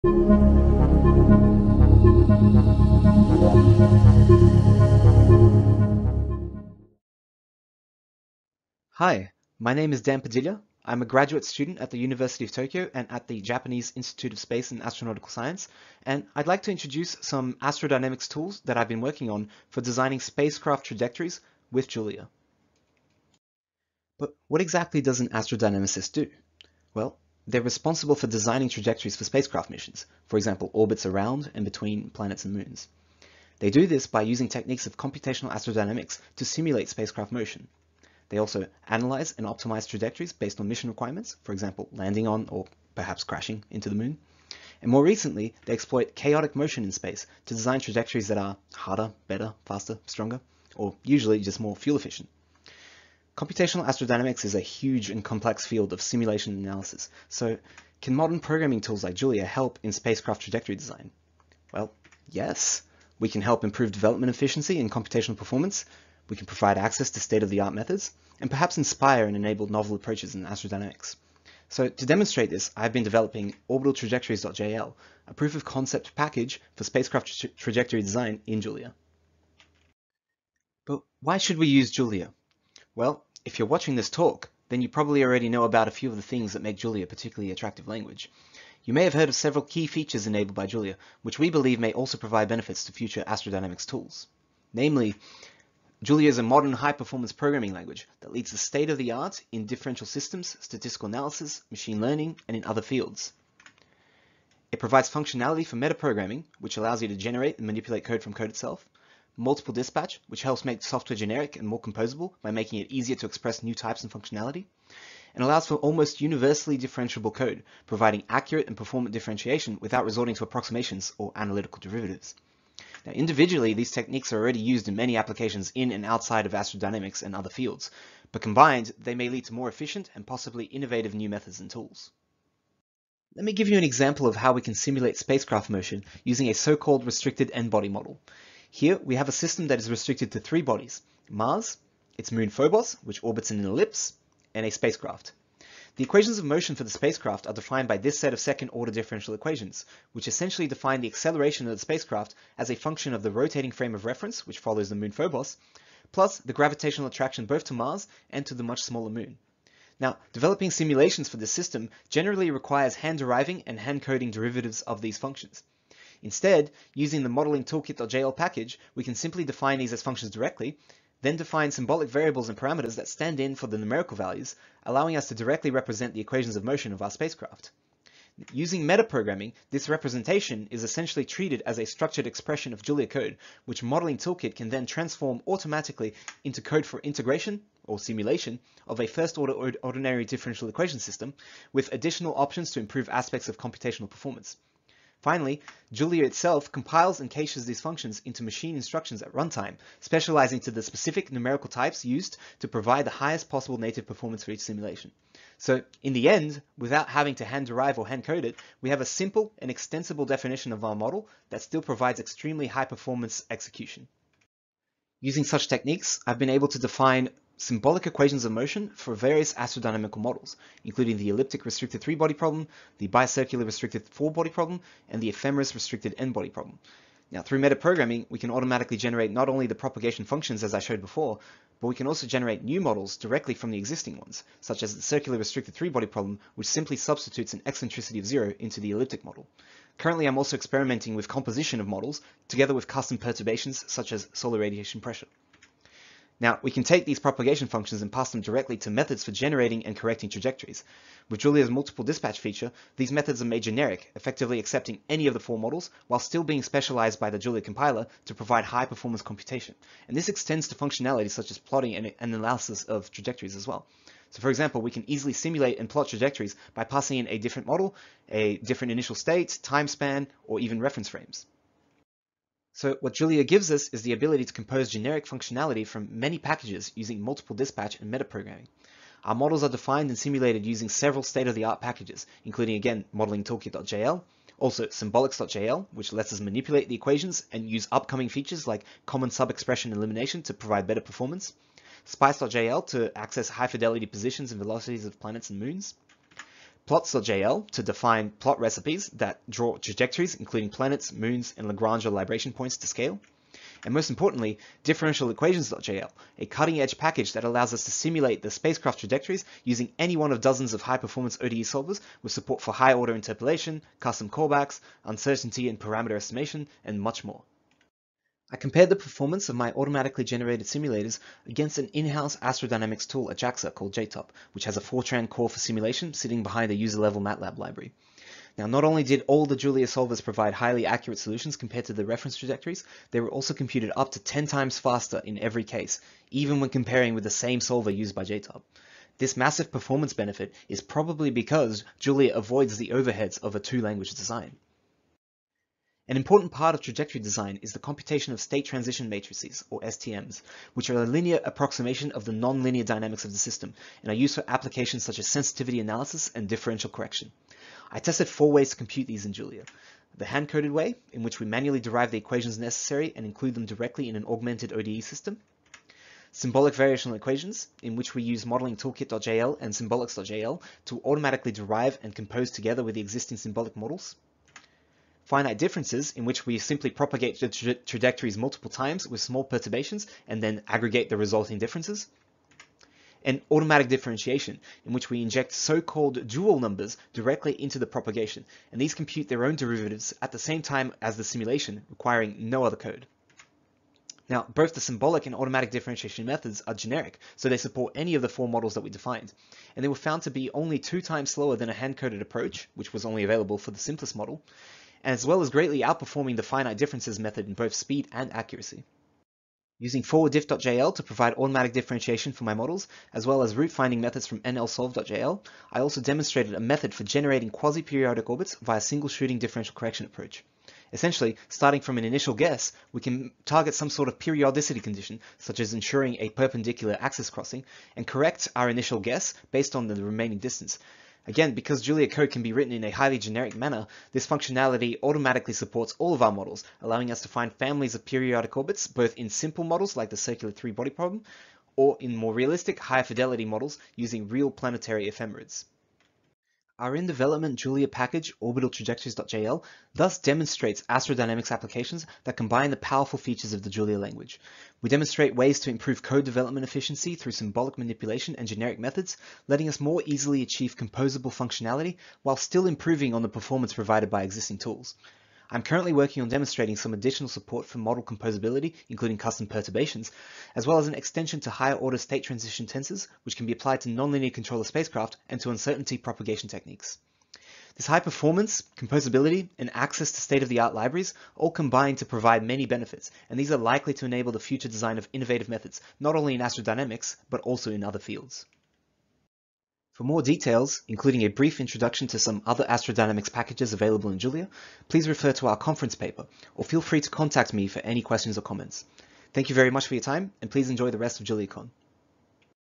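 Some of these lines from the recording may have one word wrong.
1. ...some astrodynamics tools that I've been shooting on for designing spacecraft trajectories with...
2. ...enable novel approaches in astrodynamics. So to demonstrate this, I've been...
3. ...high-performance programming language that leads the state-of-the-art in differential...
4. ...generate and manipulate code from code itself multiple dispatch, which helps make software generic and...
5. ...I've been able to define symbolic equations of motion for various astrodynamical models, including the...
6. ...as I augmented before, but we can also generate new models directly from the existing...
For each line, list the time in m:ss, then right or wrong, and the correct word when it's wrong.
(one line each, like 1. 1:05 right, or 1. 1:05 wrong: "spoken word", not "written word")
1. 0:17 wrong: "working", not "shooting"
2. 1:09 right
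3. 1:36 right
4. 1:47 right
5. 3:36 right
6. 3:50 wrong: "showed", not "augmented".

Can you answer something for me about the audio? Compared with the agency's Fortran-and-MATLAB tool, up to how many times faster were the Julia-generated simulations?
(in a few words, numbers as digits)
10 times.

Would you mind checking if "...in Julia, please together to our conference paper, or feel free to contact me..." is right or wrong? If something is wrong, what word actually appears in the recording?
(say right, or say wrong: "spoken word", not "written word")
wrong: "refer", not "together".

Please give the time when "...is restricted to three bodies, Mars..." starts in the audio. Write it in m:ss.
2:19.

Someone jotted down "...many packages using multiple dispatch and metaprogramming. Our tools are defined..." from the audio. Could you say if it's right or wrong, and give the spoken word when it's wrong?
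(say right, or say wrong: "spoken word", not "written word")
wrong: "models", not "tools".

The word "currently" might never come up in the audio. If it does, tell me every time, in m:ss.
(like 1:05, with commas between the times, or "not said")
3:59, 7:45.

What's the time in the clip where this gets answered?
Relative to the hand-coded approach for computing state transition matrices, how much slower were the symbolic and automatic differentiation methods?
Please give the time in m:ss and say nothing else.
6:40.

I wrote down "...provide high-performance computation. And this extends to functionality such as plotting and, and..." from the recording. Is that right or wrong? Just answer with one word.
right.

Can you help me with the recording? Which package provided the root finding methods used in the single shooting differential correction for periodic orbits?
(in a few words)
NLsolve.jl.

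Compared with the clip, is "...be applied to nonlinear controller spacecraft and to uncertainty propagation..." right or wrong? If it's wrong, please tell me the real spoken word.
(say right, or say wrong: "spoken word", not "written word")
right.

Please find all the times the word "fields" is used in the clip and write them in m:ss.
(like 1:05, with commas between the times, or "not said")
0:55, 1:42, 2:07, 8:07.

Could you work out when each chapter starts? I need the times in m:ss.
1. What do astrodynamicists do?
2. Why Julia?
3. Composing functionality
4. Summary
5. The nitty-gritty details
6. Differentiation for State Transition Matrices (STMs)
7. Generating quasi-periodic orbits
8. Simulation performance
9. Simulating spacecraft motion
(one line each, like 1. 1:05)
1. 0:23
2. 1:20
3. 3:34
4. 7:26
5. 4:32
6. 5:45
7. 6:49
8. 5:18
9. 2:13.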